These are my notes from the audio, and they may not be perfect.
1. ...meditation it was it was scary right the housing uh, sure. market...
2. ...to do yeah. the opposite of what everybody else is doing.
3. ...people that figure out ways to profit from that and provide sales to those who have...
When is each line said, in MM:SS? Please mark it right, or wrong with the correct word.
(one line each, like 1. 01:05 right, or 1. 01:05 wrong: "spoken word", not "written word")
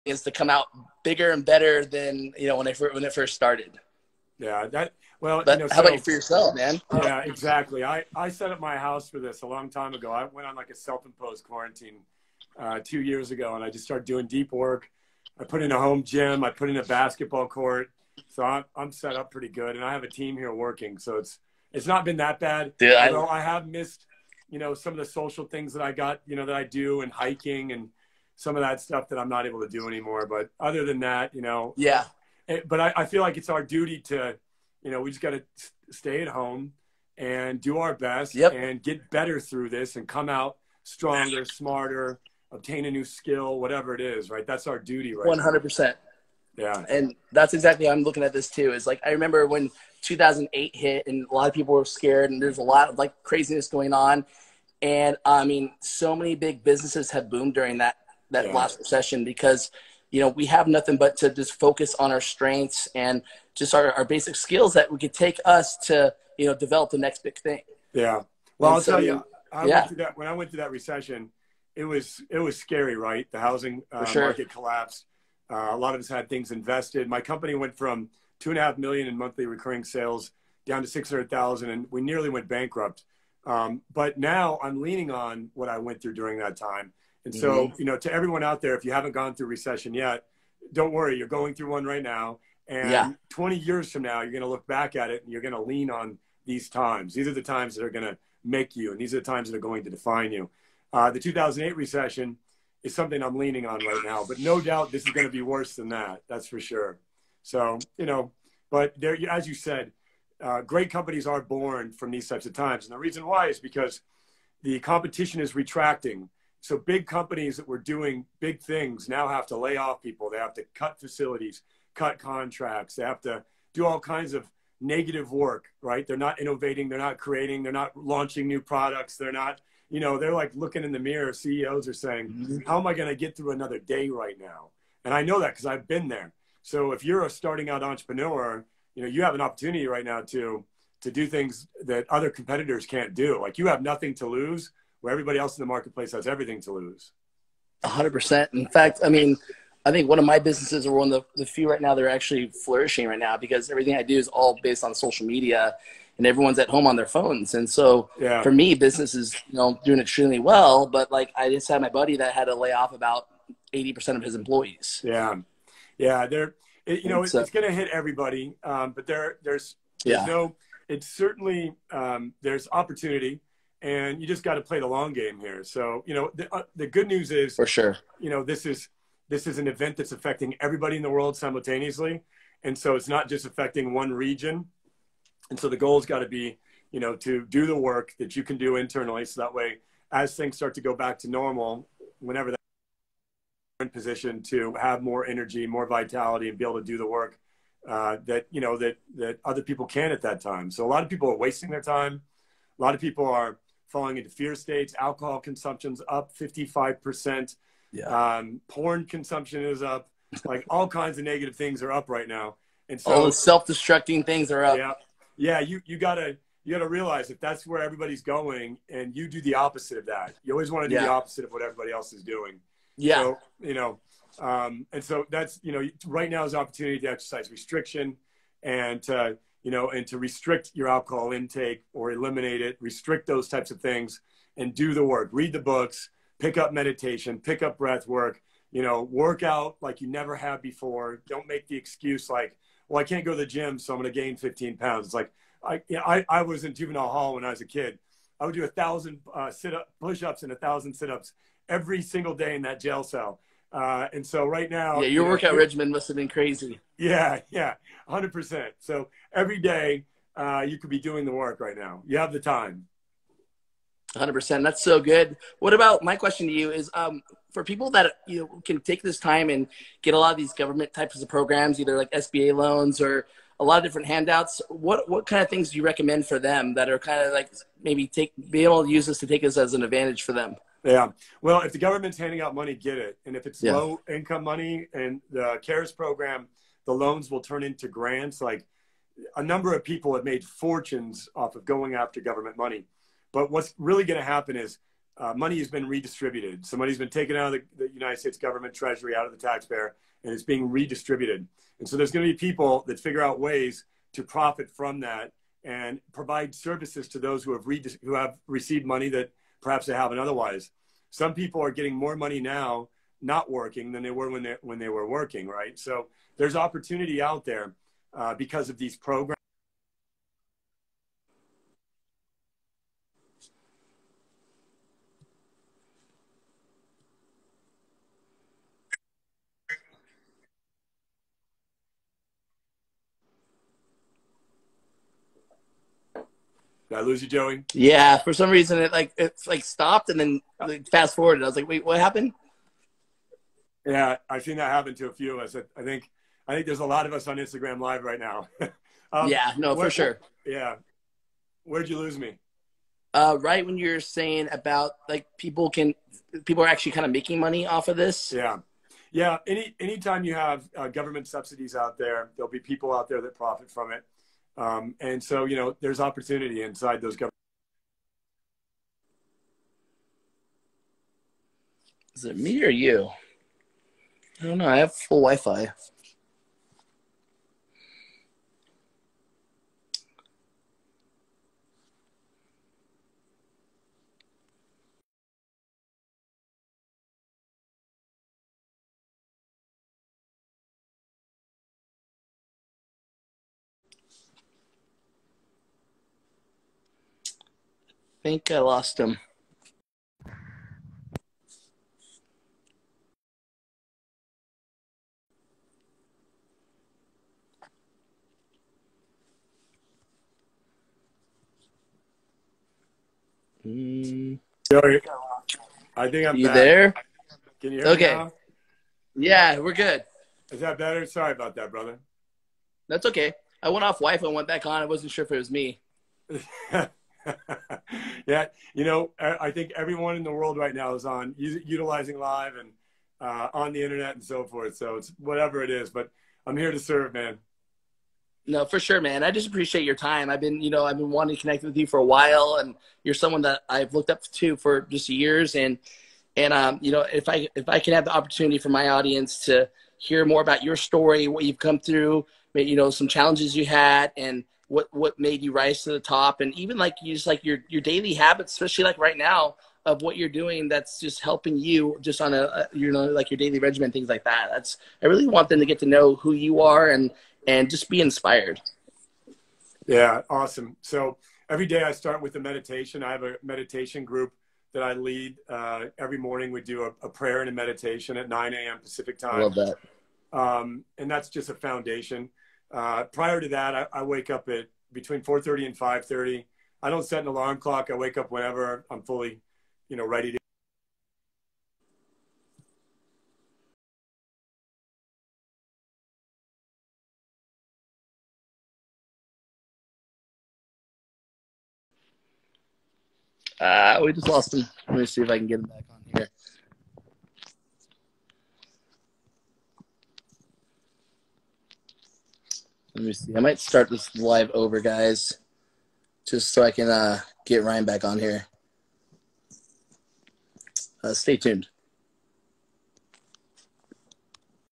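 1. 01:10 wrong: "recession", not "meditation"
2. 03:40 right
3. 05:02 wrong: "services", not "sales".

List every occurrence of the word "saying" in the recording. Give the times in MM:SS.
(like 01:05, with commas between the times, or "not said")
02:11, 05:54.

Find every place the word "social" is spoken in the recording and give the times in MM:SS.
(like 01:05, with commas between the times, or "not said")
00:25, 02:34.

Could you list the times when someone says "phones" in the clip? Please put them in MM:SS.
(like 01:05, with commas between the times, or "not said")
02:37.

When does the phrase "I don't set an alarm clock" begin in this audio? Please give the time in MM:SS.
08:06.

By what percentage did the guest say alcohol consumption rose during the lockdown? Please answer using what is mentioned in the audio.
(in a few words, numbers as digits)
55%.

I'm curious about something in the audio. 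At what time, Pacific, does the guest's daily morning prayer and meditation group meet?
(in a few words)
9 a.m.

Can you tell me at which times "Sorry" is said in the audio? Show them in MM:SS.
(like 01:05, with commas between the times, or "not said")
07:01.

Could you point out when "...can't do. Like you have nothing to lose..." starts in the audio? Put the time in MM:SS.
02:22.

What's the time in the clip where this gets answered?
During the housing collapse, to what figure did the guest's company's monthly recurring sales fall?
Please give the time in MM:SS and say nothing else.
01:20.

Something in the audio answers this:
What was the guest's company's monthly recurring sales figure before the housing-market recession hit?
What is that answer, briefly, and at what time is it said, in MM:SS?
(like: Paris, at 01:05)
2.5 million, at 01:18.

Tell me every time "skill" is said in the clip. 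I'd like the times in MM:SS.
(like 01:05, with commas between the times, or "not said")
00:43, 01:04.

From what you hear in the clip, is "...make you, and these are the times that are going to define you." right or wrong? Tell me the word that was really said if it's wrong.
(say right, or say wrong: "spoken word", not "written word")
right.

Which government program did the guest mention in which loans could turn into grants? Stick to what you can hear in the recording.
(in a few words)
CARES.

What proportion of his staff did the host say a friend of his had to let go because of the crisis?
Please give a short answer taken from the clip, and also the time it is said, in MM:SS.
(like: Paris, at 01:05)
80%, at 02:43.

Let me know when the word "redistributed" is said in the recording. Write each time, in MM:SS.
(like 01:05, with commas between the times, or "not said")
04:55, 05:00.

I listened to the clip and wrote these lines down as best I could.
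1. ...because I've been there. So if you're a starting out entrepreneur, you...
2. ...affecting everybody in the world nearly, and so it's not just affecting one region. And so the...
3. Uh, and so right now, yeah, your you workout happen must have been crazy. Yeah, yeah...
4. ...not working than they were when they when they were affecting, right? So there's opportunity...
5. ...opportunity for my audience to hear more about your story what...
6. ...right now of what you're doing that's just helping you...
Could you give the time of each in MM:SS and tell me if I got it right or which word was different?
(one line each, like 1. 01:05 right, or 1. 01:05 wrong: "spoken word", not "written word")
1. 02:15 right
2. 03:00 wrong: "simultaneously", not "nearly"
3. 04:13 wrong: "regimen", not "happen"
4. 05:13 wrong: "working", not "affecting"
5. 07:28 right
6. 07:38 right.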